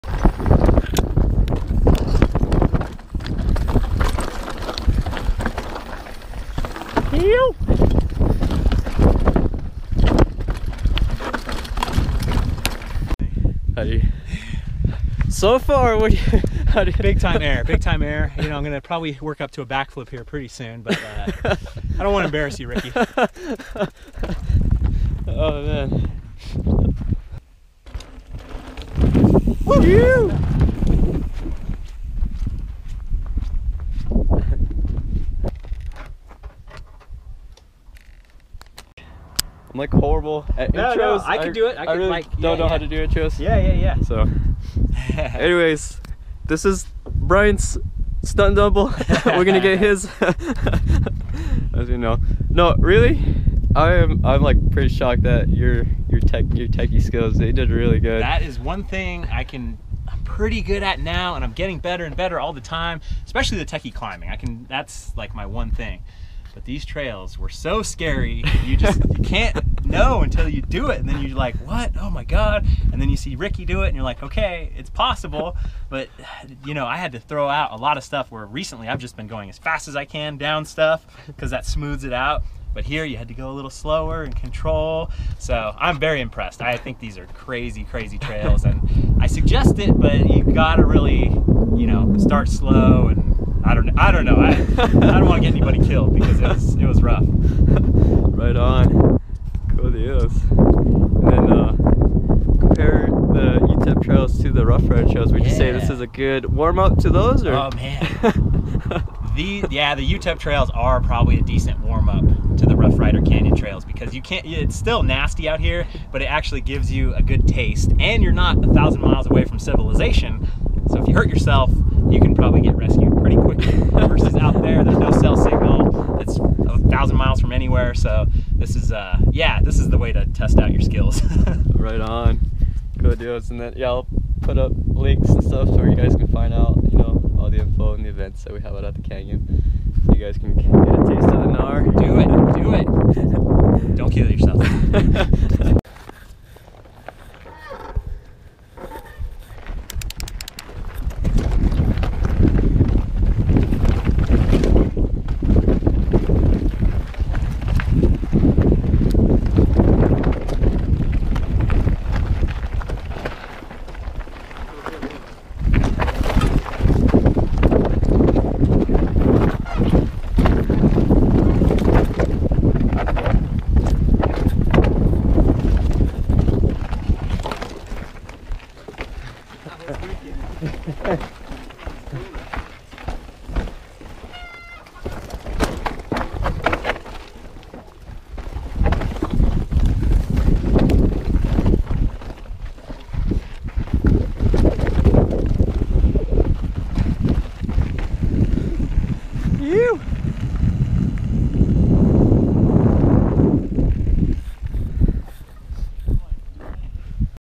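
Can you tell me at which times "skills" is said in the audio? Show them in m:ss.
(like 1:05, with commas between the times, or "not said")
0:57, 2:10.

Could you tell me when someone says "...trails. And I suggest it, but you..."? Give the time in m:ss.
1:28.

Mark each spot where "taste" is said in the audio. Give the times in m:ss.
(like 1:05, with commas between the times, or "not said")
1:57, 2:21.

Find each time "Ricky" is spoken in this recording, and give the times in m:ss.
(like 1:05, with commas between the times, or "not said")
0:22, 1:13.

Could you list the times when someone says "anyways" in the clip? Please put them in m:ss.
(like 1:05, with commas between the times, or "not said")
0:45.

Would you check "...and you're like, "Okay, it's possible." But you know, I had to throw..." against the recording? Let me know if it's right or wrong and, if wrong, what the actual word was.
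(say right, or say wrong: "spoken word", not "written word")
right.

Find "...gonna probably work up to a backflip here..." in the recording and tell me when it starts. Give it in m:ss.
0:18.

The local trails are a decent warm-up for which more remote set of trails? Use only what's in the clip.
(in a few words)
Rough Rider Canyon trails.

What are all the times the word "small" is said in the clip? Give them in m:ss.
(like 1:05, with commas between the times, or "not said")
not said.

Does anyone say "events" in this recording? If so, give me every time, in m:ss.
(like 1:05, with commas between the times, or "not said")
2:18.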